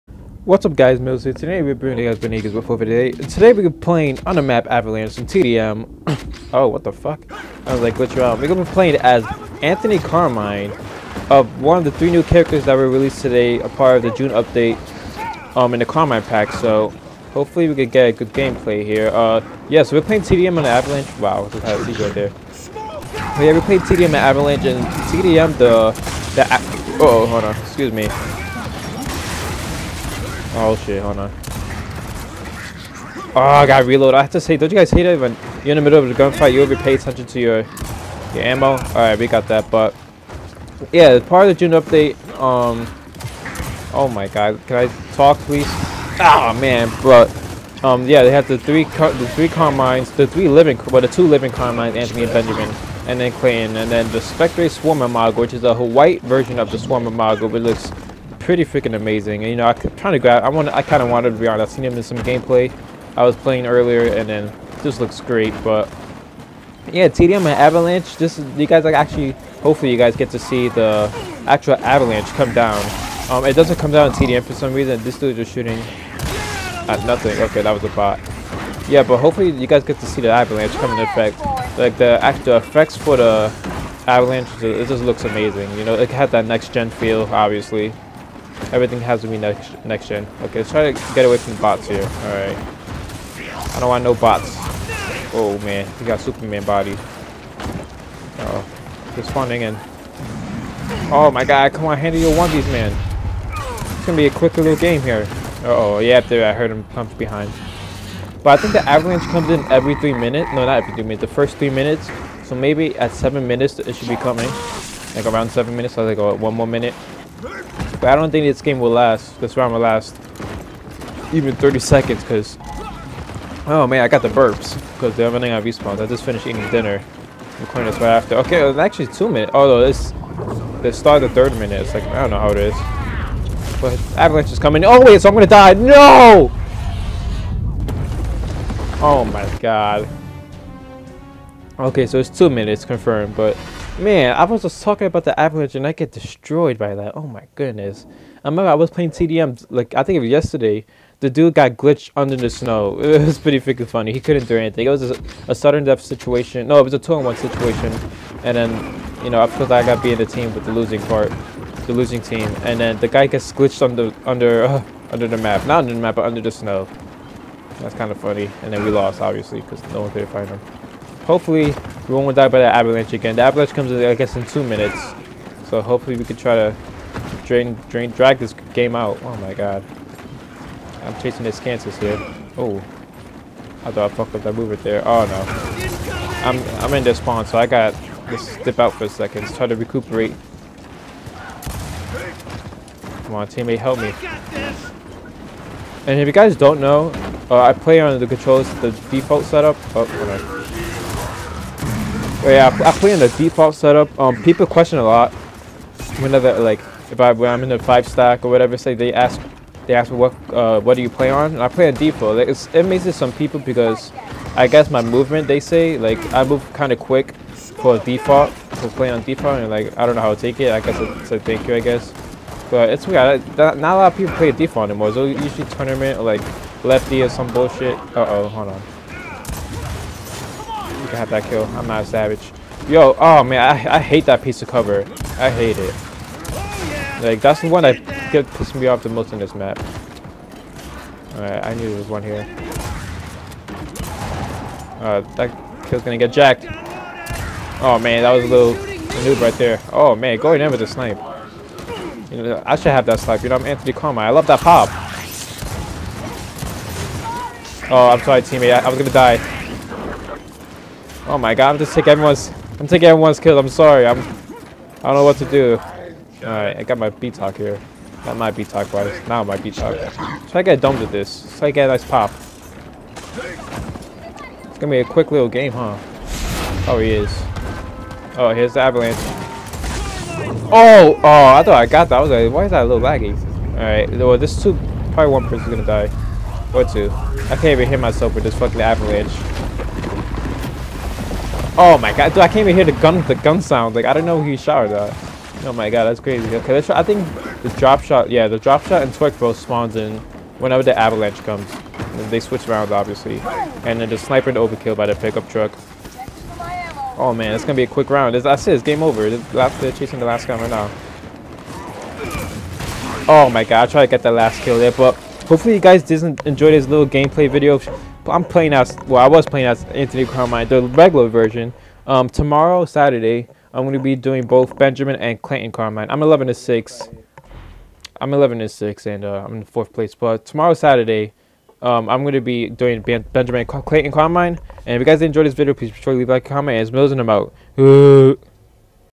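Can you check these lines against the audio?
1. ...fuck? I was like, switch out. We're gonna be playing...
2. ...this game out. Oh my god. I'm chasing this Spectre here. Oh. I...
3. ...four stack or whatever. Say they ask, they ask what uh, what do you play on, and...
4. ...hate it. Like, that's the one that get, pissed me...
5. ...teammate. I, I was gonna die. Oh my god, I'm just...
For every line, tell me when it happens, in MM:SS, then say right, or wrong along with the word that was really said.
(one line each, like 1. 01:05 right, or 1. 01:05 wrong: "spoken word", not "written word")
1. 00:06 wrong: "glitch", not "switch"
2. 02:58 wrong: "Kansas", not "Spectre"
3. 03:27 wrong: "five", not "four"
4. 03:55 right
5. 04:18 right.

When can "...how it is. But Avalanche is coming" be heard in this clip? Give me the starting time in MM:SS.
02:12.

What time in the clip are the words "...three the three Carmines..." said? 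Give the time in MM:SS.
00:48.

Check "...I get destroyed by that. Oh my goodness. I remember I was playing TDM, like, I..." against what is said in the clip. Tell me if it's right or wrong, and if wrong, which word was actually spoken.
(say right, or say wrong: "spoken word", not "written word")
right.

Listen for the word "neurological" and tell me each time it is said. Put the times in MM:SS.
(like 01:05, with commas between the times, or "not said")
not said.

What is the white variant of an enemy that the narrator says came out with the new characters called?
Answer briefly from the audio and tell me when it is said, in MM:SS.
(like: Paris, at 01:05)
Spectre Swarmer Mago, at 00:54.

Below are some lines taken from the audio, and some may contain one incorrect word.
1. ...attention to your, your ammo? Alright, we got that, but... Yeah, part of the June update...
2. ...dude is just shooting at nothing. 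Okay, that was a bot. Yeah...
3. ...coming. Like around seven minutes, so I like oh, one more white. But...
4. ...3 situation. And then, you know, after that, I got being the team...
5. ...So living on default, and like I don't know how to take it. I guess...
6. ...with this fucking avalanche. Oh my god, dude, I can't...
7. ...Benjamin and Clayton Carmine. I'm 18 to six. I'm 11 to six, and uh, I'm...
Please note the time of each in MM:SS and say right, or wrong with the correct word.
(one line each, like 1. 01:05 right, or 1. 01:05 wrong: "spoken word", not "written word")
1. 00:36 right
2. 01:15 right
3. 01:54 wrong: "minute", not "white"
4. 02:37 wrong: "1", not "3"
5. 03:38 wrong: "playing", not "living"
6. 04:48 right
7. 05:24 wrong: "11", not "18".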